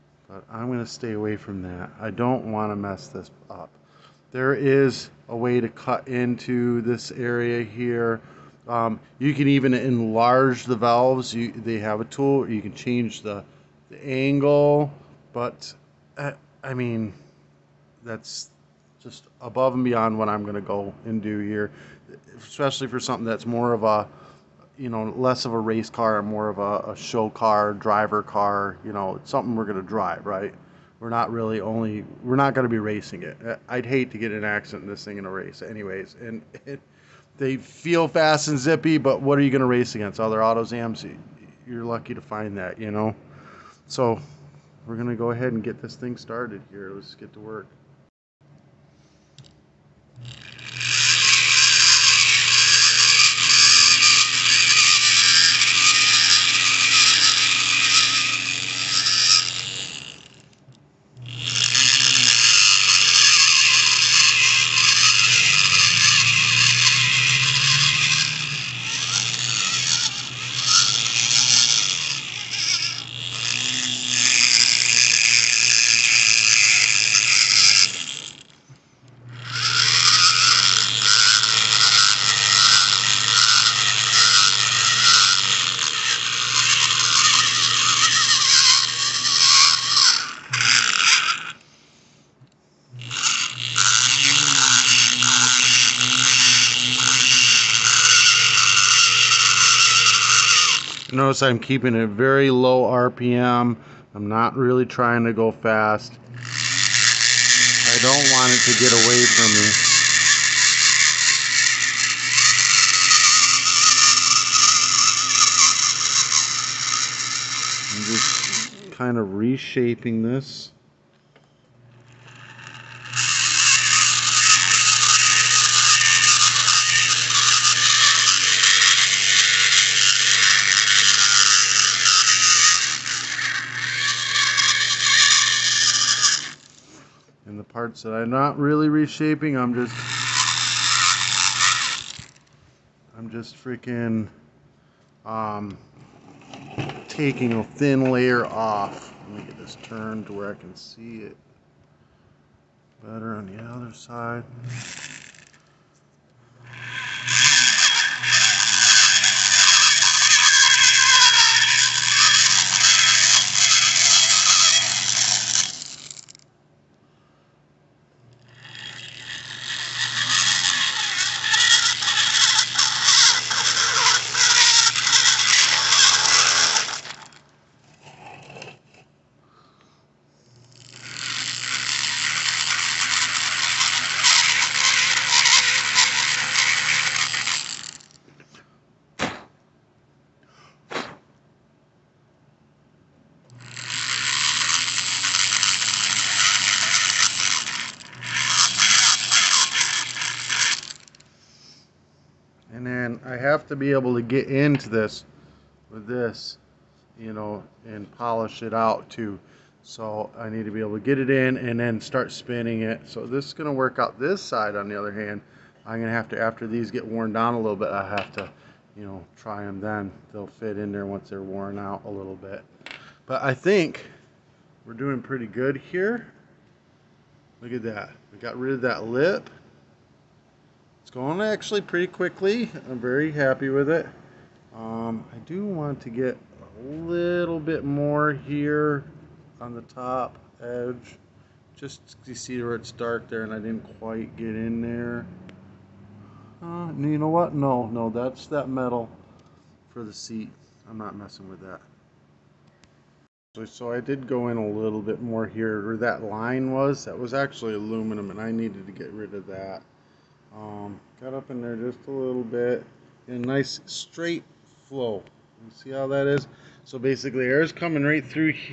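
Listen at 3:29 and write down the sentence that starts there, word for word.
So I need to be able to get it in and then start spinning it.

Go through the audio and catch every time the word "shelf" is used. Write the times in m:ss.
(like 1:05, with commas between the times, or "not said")
not said.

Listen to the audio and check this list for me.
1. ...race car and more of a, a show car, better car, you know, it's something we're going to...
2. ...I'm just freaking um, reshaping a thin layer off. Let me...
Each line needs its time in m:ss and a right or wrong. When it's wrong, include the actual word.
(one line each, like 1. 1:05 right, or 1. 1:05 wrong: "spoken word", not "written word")
1. 0:25 wrong: "driver", not "better"
2. 2:23 wrong: "taking", not "reshaping".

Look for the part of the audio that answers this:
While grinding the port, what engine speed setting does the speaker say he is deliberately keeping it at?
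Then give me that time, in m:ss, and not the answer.
1:42.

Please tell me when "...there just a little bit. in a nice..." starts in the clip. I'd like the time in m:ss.
4:21.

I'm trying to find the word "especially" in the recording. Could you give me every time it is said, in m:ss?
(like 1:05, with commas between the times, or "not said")
0:22.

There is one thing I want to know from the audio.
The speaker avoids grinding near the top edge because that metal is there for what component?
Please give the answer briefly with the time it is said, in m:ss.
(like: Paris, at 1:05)
The seat, at 4:10.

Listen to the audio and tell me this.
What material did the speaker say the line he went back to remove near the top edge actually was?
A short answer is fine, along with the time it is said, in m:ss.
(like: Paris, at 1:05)
Aluminum, at 4:17.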